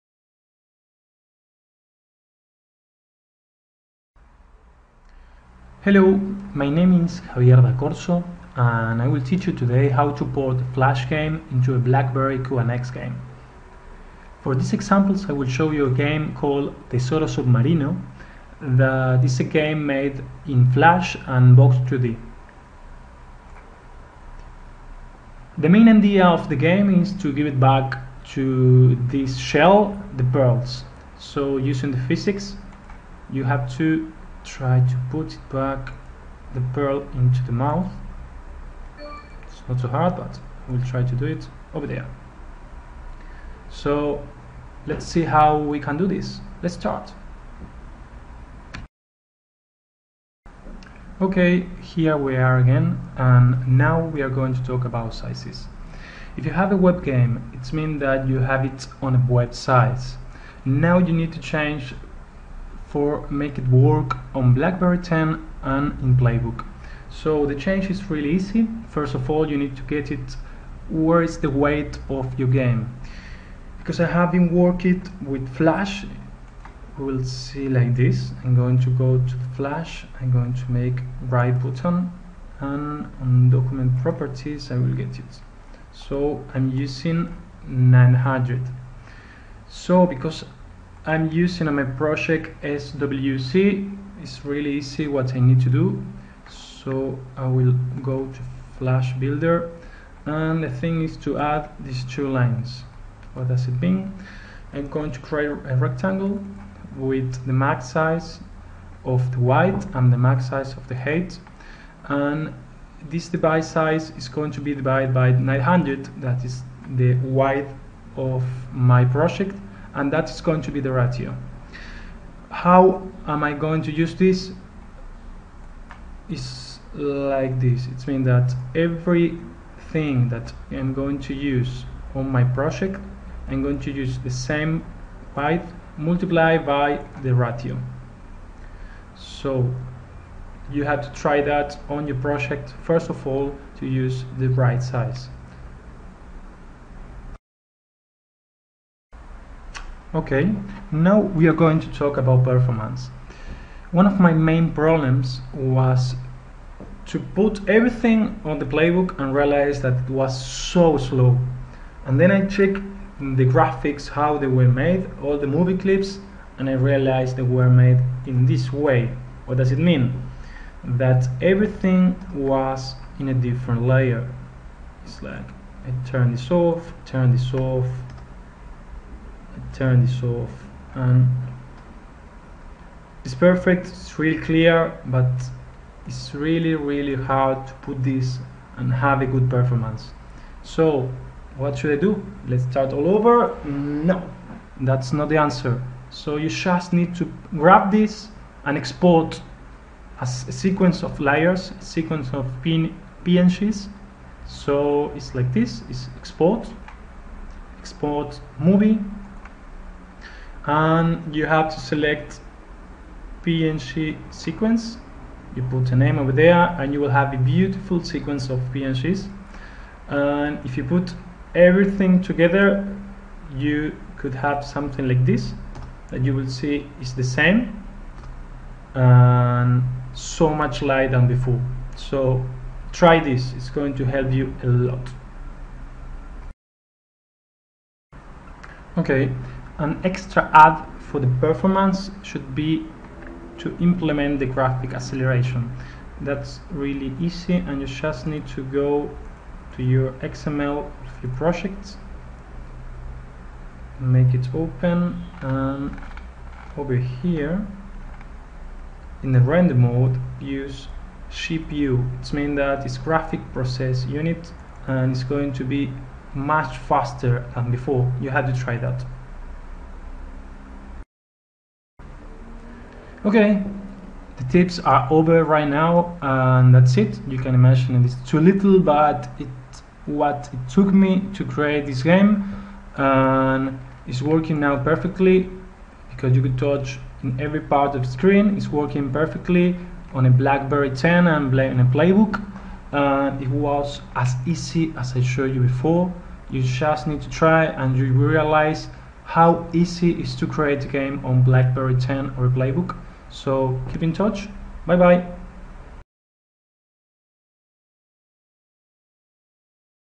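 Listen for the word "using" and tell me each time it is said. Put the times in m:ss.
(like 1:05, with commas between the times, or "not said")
0:31, 1:26, 1:31.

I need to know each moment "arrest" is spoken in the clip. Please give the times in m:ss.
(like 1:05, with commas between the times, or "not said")
not said.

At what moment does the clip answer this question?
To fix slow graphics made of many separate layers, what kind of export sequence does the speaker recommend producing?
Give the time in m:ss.
3:33.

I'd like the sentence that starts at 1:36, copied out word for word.
So I will go to Flash Builder and the thing is to add these two lines.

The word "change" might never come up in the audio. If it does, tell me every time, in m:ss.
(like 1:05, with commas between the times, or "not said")
1:01, 1:07.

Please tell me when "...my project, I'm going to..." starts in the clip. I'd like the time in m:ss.
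2:12.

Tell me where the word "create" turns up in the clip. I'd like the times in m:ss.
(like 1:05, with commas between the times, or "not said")
1:45, 4:41, 5:00.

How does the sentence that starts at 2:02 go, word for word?
How am I going to use this?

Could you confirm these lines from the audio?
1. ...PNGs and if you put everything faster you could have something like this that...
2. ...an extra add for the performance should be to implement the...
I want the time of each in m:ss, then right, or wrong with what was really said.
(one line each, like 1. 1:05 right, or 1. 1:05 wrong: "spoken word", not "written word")
1. 3:38 wrong: "together", not "faster"
2. 3:59 right.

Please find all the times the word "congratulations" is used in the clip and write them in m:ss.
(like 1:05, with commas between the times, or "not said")
not said.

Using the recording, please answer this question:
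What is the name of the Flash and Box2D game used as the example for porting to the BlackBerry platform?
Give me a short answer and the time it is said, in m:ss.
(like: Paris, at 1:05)
Tesoro Submarino, at 0:16.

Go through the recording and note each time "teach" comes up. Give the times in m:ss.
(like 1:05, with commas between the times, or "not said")
0:09.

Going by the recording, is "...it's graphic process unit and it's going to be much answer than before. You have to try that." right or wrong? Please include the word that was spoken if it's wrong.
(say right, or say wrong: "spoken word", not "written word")
wrong: "faster", not "answer".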